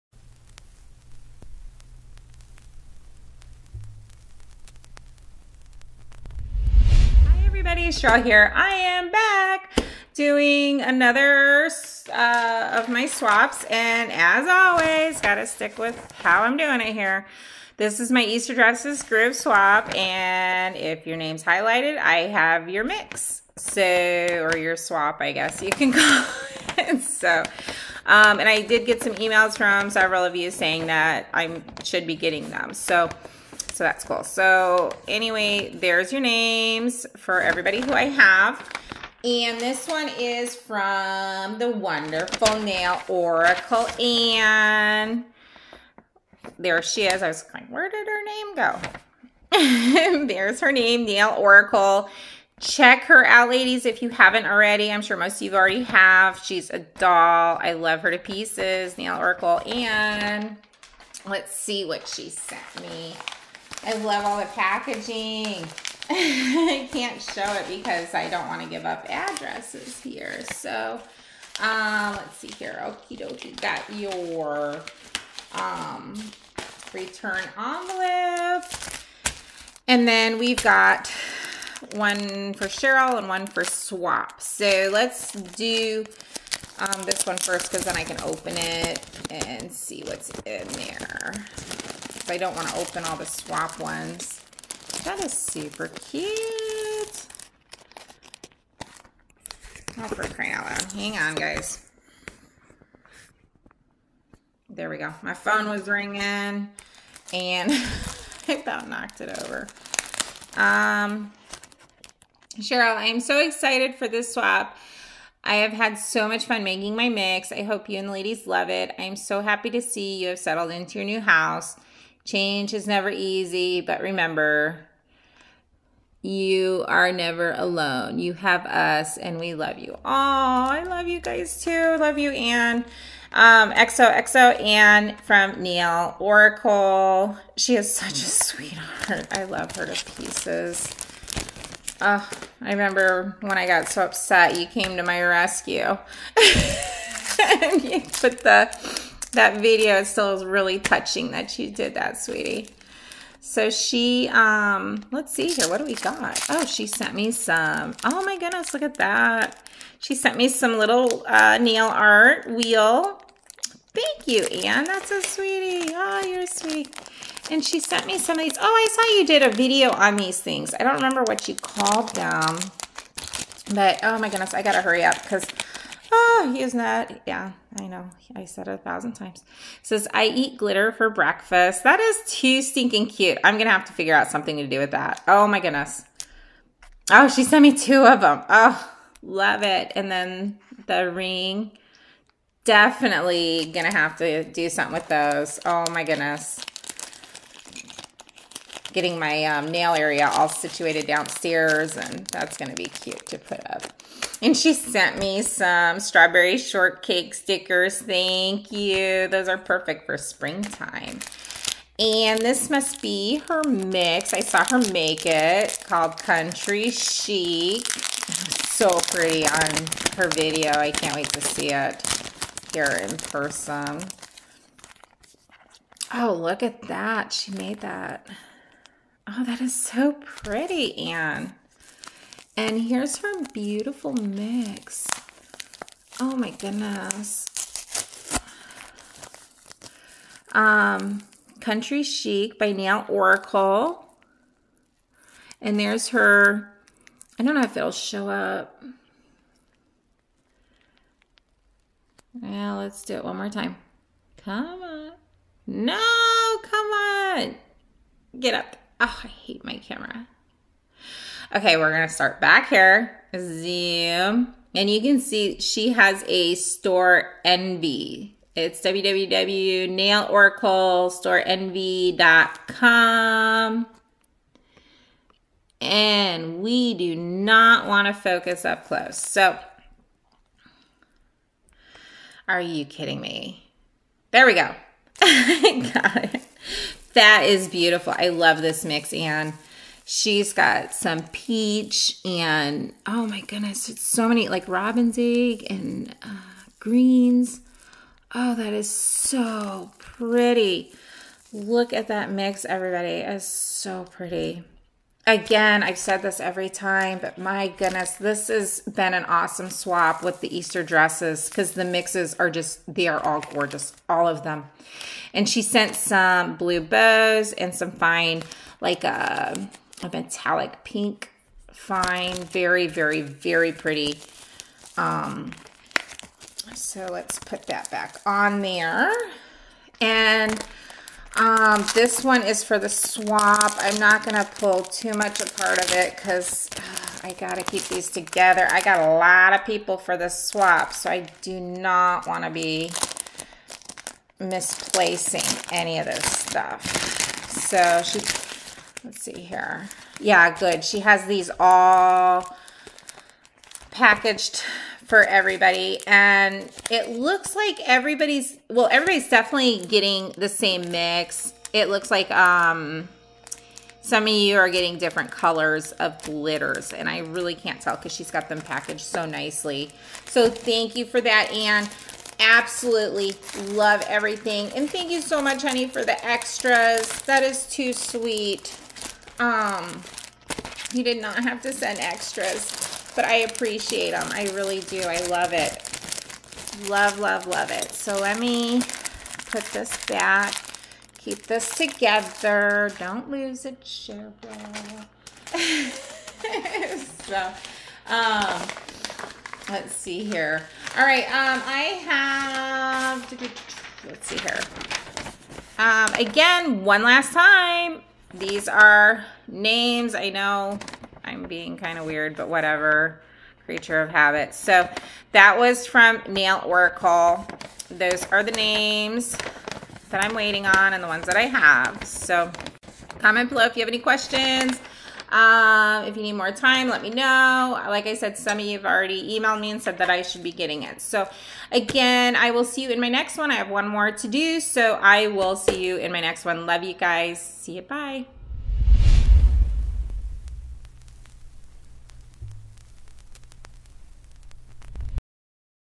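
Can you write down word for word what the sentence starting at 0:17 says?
This is my Easter dresses group swap.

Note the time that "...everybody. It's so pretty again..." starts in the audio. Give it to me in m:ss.
5:02.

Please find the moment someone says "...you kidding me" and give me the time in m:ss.
4:42.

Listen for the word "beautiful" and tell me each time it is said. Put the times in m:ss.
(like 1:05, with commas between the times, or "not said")
3:53, 4:47.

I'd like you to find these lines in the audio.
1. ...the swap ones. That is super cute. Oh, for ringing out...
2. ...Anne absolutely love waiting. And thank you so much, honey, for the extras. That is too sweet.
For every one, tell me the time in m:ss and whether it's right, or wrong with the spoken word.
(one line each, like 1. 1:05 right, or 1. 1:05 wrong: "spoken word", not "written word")
1. 1:33 wrong: "crying", not "ringing"
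2. 6:11 wrong: "everything", not "waiting".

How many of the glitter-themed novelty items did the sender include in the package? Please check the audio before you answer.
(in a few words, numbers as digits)
2.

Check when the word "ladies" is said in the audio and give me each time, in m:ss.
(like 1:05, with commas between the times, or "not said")
0:53, 1:58.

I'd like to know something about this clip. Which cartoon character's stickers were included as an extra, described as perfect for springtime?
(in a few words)
Strawberry Shortcake.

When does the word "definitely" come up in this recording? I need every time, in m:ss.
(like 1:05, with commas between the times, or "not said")
3:12, 5:59.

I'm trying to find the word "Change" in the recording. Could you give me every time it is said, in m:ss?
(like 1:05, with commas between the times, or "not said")
2:02.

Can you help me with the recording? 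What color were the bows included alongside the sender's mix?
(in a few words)
blue.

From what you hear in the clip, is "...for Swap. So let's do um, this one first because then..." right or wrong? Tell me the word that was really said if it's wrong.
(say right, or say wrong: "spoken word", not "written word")
right.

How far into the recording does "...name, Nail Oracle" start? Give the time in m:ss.
0:50.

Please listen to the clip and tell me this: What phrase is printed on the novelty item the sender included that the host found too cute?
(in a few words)
I eat glitter for breakfast.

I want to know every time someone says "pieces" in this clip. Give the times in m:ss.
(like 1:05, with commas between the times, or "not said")
0:58, 2:20.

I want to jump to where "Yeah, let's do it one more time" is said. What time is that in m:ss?
4:12.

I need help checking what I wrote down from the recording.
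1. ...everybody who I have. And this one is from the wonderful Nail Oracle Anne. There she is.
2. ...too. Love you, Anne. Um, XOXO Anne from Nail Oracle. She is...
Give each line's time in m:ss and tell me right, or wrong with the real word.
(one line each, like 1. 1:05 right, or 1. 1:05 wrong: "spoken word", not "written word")
1. 0:37 right
2. 2:11 right.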